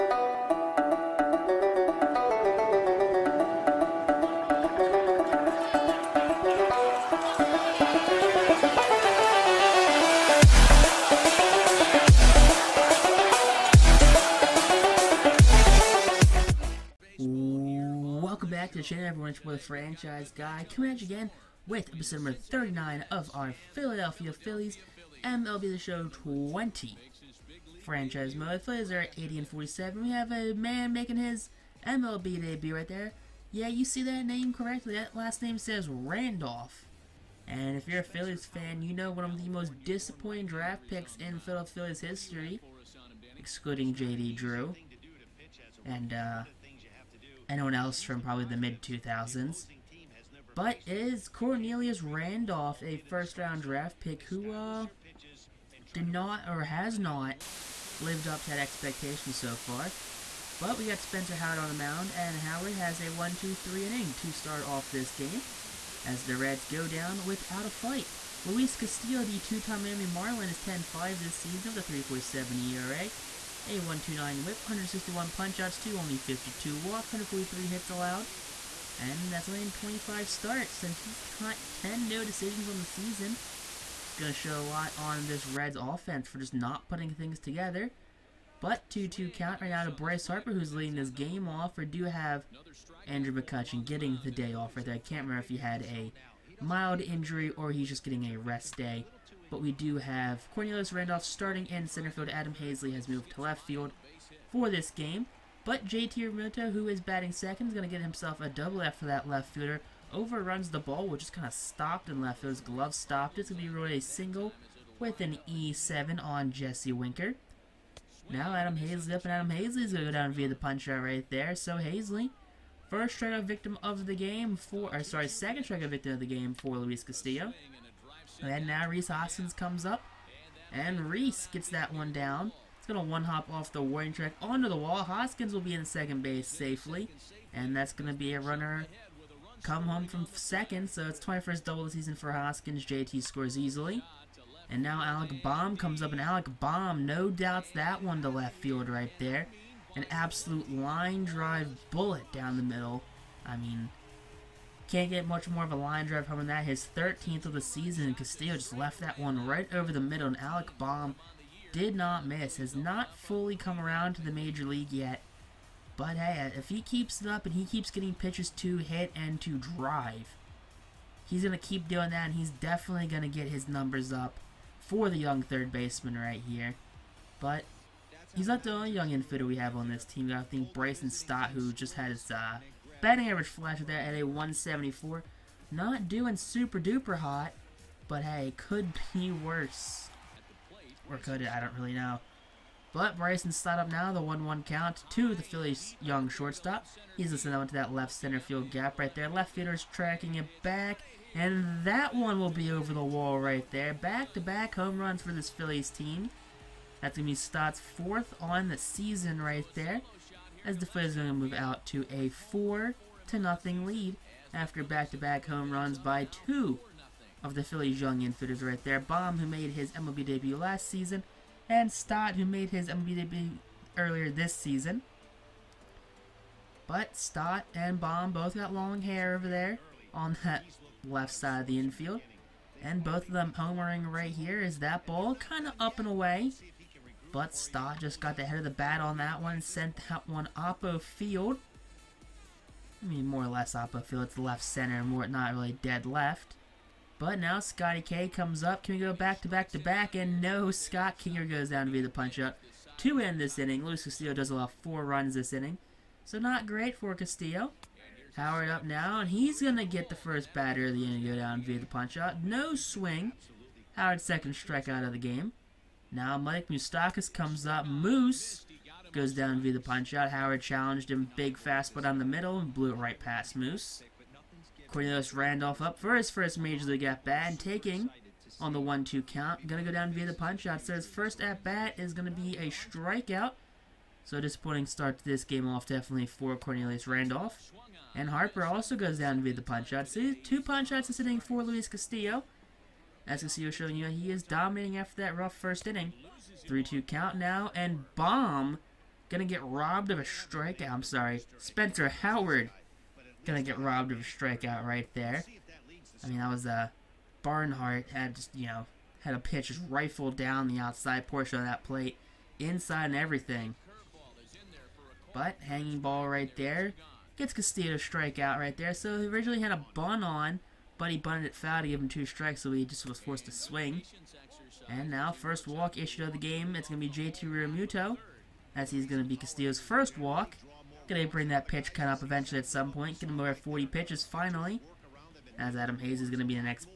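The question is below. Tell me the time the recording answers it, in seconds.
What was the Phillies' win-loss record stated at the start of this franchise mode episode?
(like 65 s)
29 s.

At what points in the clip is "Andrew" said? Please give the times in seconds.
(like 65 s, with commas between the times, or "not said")
93 s.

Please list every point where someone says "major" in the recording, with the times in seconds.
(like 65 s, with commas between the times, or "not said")
164 s, 276 s.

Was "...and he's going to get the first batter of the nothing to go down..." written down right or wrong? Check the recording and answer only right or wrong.
wrong.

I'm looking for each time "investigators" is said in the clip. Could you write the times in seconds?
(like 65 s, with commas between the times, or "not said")
not said.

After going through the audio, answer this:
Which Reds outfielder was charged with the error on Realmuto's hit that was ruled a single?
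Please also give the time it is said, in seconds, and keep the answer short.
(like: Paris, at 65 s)
Jesse Winker, at 116 s.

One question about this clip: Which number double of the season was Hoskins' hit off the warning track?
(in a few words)
21st.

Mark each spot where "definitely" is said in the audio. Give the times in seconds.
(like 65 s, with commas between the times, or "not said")
172 s, 285 s.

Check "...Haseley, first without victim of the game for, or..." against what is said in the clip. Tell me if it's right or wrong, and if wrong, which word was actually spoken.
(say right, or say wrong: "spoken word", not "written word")
wrong: "strikeout", not "without".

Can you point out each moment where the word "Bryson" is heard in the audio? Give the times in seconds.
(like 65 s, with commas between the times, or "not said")
180 s, 193 s.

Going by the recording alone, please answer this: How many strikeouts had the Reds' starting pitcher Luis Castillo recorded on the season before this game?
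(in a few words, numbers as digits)
161.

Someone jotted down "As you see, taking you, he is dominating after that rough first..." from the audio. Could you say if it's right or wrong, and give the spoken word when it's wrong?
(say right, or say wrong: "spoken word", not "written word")
wrong: "showing", not "taking".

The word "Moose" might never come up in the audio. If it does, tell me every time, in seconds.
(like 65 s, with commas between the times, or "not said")
267 s, 273 s.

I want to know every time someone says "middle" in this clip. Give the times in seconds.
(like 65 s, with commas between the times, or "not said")
152 s, 159 s, 272 s.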